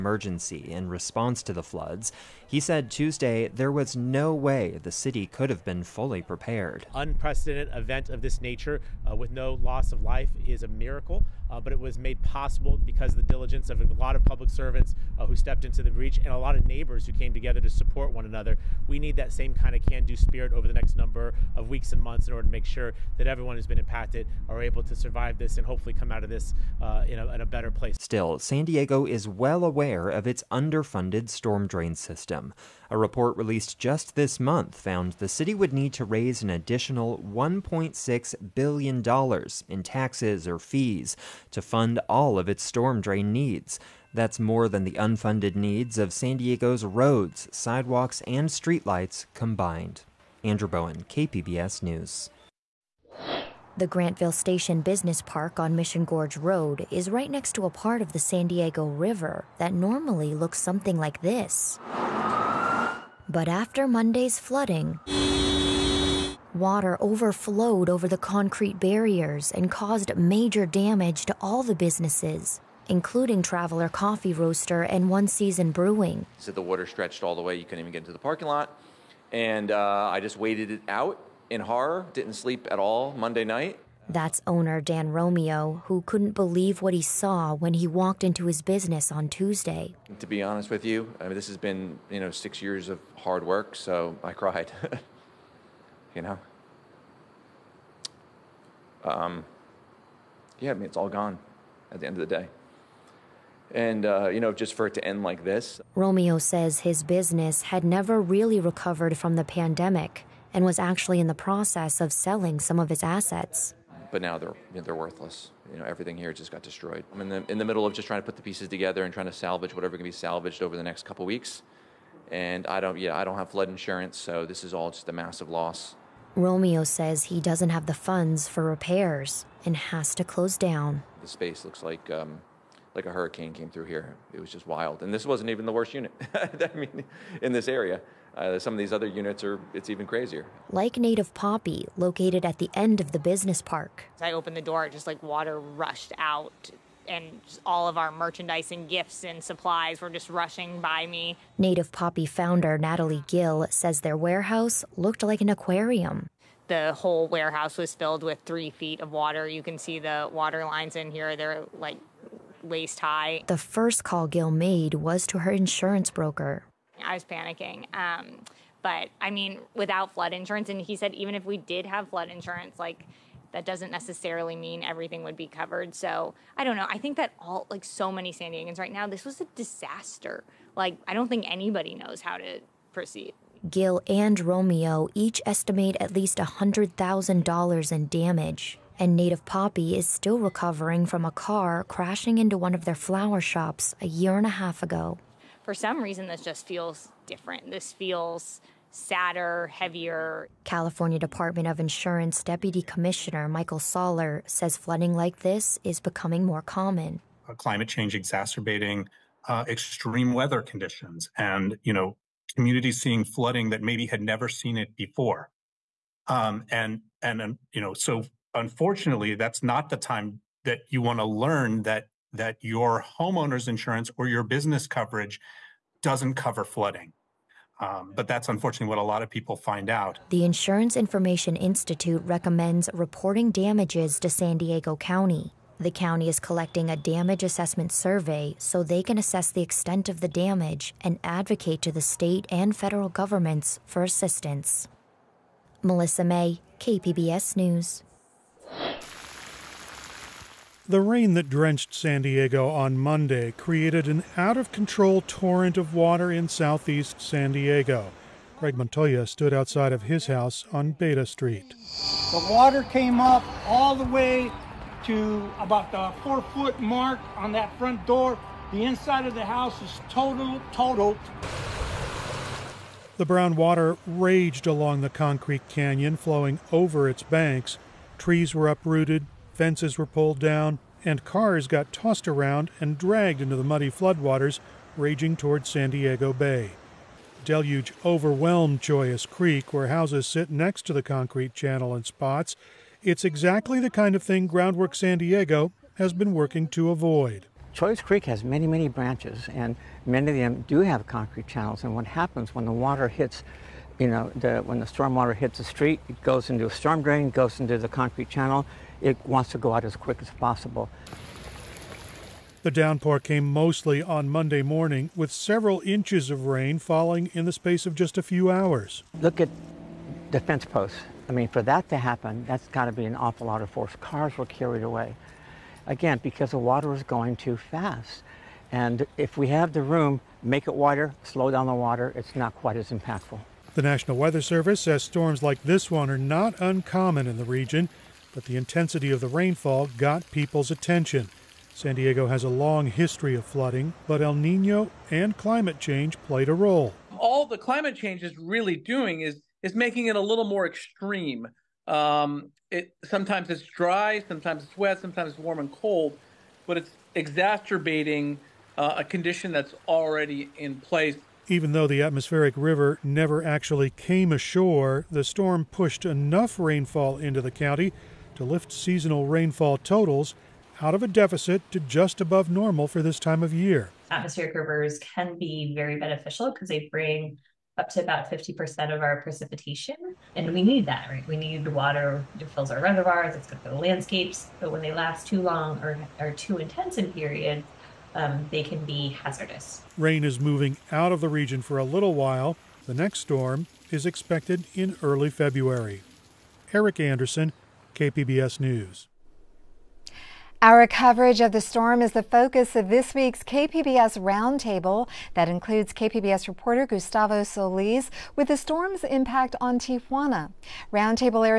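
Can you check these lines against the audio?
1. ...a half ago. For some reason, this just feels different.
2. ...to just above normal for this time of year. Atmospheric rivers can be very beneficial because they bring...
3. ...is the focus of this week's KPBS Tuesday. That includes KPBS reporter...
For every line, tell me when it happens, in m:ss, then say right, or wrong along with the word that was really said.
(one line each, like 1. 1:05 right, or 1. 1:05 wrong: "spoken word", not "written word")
1. 3:14 right
2. 6:11 right
3. 6:42 wrong: "Roundtable", not "Tuesday".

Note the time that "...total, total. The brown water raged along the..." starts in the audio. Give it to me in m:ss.
4:30.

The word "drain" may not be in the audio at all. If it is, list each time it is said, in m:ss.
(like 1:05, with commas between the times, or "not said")
0:31, 0:42, 5:07.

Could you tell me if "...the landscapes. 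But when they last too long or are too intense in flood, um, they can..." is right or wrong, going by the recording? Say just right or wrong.
wrong.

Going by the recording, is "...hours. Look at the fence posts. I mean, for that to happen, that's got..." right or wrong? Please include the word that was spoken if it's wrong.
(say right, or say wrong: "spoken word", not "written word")
right.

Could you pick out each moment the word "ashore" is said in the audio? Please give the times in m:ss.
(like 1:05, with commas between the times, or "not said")
6:04.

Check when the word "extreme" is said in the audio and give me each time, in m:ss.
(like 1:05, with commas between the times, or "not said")
3:29, 5:50.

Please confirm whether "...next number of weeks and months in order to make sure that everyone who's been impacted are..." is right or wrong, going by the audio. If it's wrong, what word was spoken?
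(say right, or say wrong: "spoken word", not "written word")
right.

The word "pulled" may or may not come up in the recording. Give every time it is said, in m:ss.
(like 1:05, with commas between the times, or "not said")
4:40.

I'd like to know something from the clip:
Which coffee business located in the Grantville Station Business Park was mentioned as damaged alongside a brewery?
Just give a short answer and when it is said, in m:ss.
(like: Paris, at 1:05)
Traveler Coffee Roaster, at 1:13.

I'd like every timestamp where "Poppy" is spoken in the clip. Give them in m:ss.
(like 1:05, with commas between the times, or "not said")
2:21, 2:31, 3:09.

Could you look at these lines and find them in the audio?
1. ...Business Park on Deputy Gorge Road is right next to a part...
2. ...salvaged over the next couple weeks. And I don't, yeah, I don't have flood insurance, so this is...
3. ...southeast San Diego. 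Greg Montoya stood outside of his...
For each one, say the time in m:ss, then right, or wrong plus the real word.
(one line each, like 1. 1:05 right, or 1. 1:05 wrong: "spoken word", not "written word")
1. 0:54 wrong: "Mission", not "Deputy"
2. 2:00 right
3. 4:16 right.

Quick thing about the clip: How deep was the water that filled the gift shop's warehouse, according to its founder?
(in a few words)
3 feet.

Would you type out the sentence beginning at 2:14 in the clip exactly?
It was just wild, and this wasn't even the worst unit.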